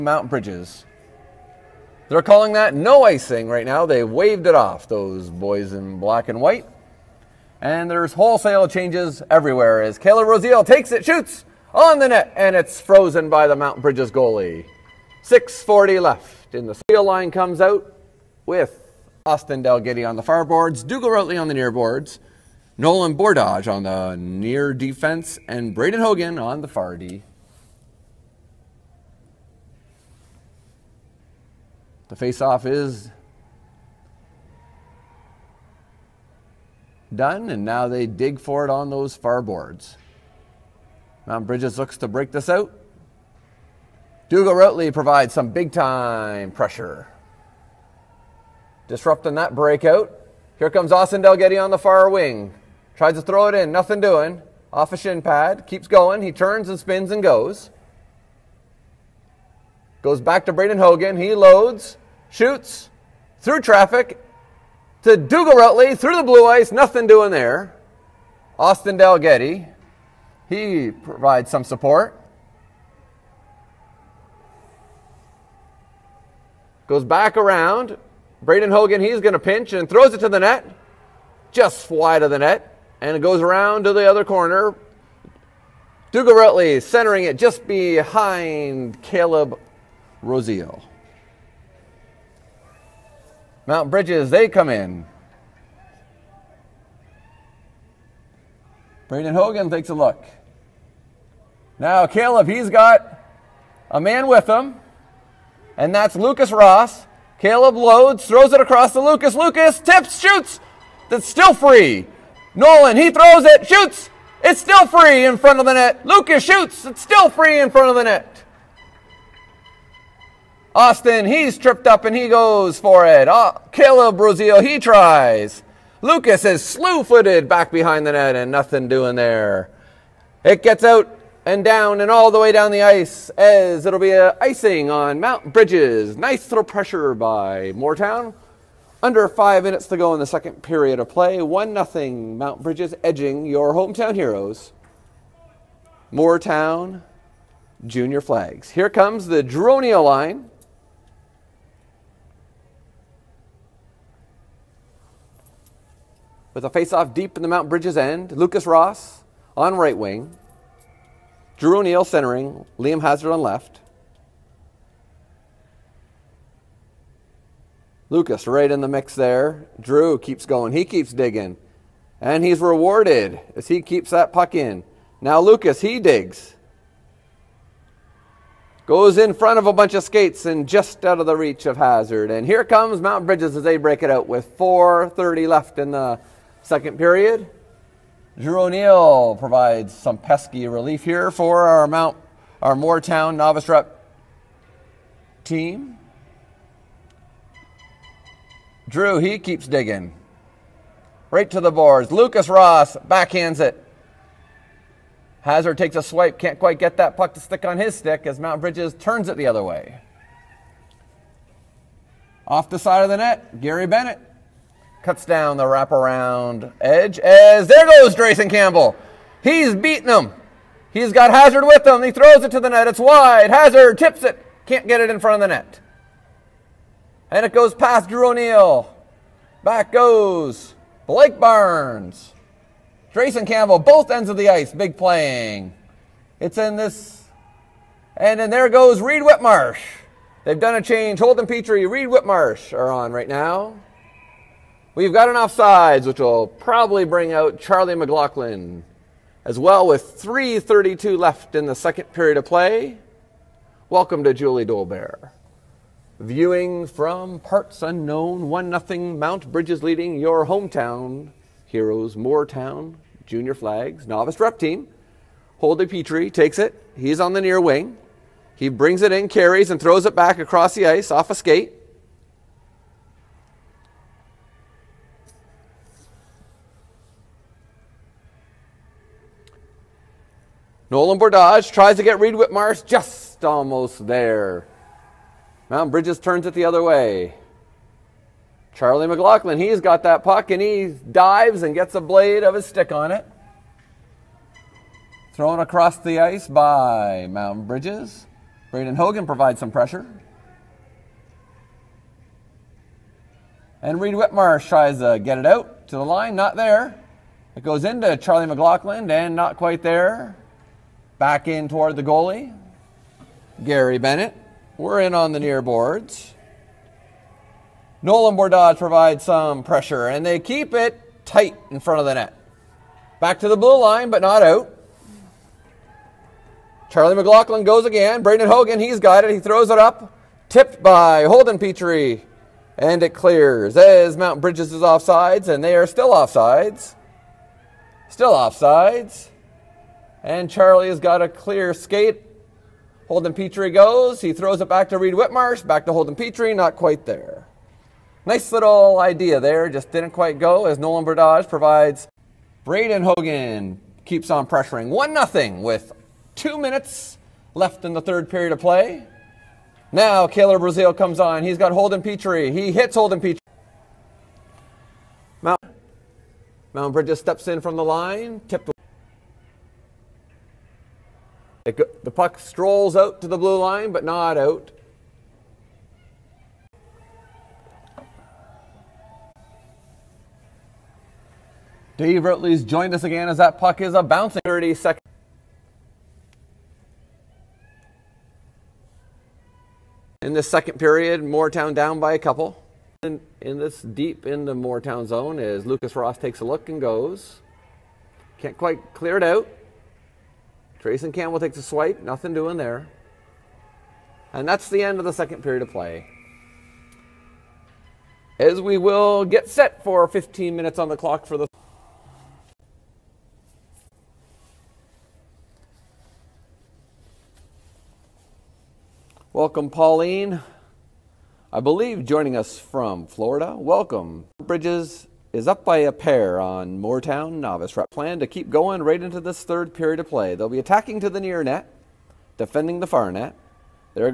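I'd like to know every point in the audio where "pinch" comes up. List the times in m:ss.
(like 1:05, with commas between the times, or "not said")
1:19.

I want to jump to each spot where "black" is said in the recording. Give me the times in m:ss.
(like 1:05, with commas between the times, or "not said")
0:05.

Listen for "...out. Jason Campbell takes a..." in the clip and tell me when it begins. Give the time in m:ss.
6:39.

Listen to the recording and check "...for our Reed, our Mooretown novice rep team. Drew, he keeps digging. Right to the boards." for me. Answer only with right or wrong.
wrong.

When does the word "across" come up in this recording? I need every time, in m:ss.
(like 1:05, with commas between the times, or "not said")
1:48, 4:30, 4:55.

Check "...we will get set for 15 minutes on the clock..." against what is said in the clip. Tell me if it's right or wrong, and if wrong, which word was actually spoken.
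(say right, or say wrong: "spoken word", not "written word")
right.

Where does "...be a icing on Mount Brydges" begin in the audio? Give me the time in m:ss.
2:13.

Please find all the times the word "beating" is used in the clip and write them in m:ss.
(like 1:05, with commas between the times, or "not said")
3:39.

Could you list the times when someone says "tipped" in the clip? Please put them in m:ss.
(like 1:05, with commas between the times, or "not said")
5:30, 6:08.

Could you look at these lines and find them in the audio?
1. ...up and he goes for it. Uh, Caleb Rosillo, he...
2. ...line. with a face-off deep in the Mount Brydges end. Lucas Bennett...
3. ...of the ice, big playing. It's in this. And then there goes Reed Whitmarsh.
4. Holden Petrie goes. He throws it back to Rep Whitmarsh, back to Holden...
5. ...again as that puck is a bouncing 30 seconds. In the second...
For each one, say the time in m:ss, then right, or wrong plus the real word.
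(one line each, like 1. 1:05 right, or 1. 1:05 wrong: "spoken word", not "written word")
1. 2:01 right
2. 2:30 wrong: "Ross", not "Bennett"
3. 3:54 right
4. 5:43 wrong: "Reed", not "Rep"
5. 6:23 right.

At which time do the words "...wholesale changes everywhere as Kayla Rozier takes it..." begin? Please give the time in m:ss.
0:08.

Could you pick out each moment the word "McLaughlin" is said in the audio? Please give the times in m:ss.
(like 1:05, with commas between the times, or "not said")
4:07, 4:49, 5:08, 5:27.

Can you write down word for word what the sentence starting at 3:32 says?
Off the side of the net, Gary Bennett cuts down the wraparound edge as there goes Drayson Campbell.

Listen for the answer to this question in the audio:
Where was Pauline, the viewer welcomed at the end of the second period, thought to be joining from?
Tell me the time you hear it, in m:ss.
7:03.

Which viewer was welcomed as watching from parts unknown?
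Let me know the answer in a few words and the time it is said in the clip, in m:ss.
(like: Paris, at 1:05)
Julie Dolbear, at 4:14.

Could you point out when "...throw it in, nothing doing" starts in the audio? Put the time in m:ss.
0:53.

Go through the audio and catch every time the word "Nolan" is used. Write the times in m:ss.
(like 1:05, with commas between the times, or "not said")
0:22, 1:52, 4:40, 5:18, 5:50.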